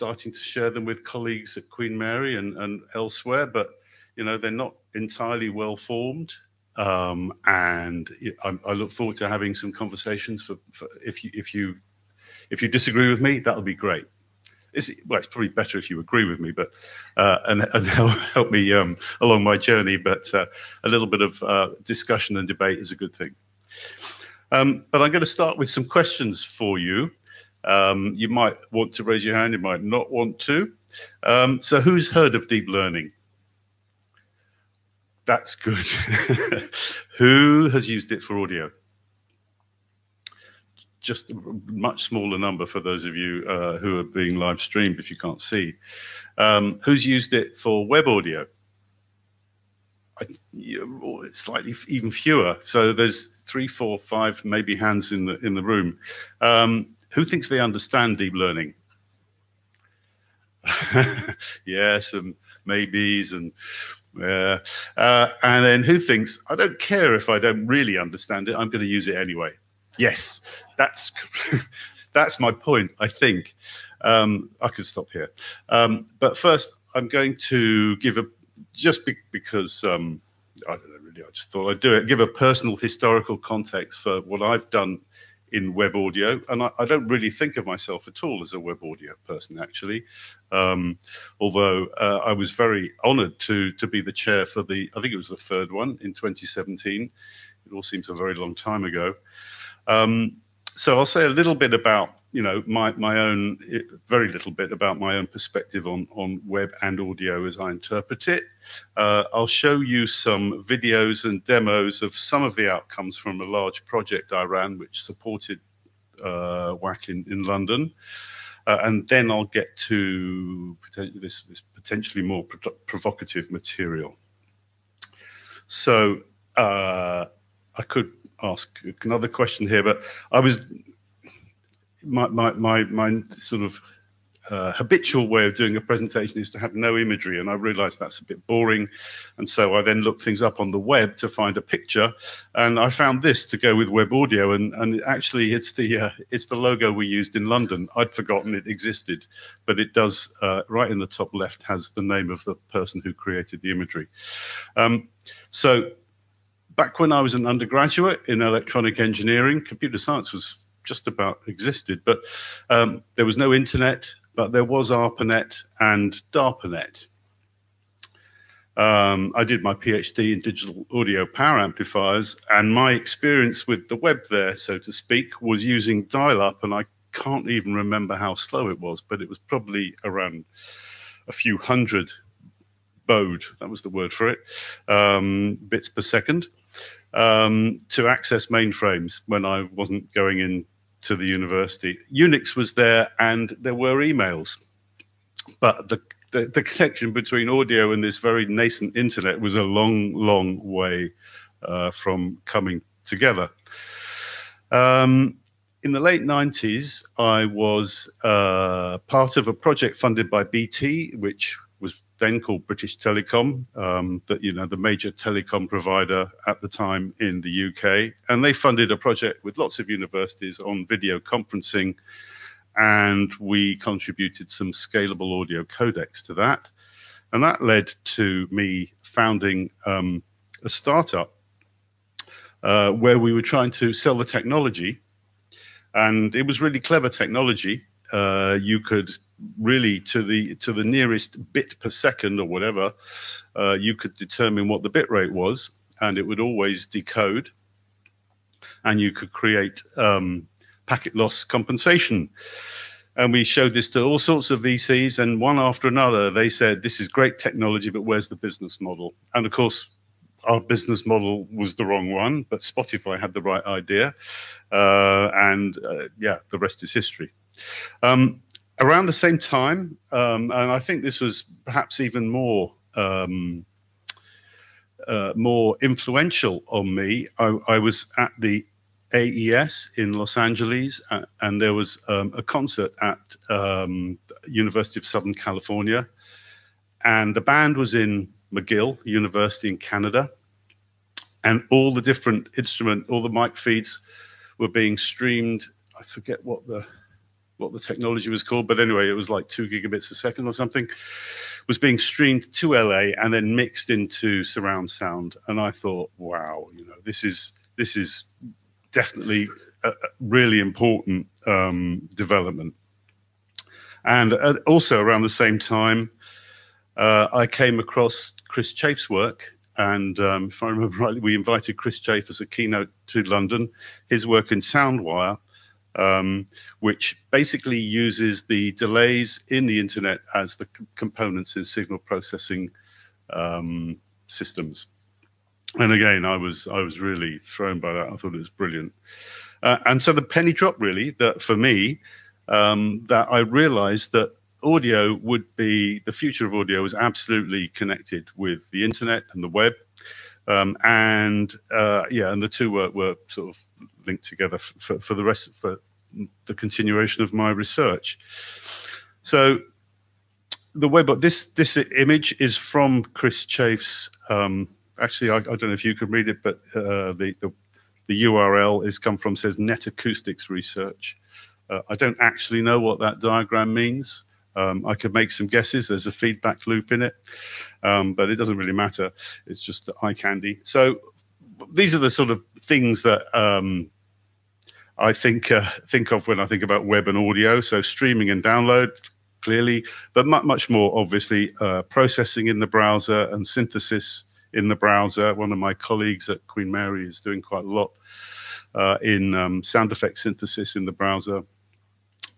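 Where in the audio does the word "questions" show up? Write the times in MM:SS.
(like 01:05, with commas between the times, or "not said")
00:25, 02:09.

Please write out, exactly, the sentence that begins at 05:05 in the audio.
And I thought, wow, you know, this is this is definitely a, really important um, development.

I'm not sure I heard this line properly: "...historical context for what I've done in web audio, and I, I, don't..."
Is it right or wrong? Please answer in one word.
right.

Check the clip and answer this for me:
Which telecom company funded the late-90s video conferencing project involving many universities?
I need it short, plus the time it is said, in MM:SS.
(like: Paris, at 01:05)
BT, at 03:30.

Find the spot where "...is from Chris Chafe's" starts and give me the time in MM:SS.
06:02.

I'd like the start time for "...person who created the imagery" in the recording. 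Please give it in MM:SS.
02:32.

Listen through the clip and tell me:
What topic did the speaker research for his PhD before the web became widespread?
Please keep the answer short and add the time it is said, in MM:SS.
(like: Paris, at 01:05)
digital audio power amplifiers, at 02:50.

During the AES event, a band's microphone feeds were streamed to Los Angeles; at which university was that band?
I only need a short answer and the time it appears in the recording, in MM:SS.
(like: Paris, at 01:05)
McGill University, at 04:48.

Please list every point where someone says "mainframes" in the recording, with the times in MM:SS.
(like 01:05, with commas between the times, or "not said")
03:08.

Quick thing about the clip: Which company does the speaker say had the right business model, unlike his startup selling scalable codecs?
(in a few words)
Spotify.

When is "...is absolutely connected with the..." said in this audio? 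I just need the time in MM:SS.
05:46.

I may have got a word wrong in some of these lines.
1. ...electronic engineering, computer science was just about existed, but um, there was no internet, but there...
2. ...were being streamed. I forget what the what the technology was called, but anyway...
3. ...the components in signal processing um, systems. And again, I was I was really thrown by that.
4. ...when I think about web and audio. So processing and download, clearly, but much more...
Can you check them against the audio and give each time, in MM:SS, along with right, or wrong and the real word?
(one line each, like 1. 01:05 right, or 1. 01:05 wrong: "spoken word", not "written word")
1. 02:38 right
2. 04:54 right
3. 05:30 right
4. 06:26 wrong: "streaming", not "processing".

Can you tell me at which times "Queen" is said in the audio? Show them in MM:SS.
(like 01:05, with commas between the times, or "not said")
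00:01, 06:36.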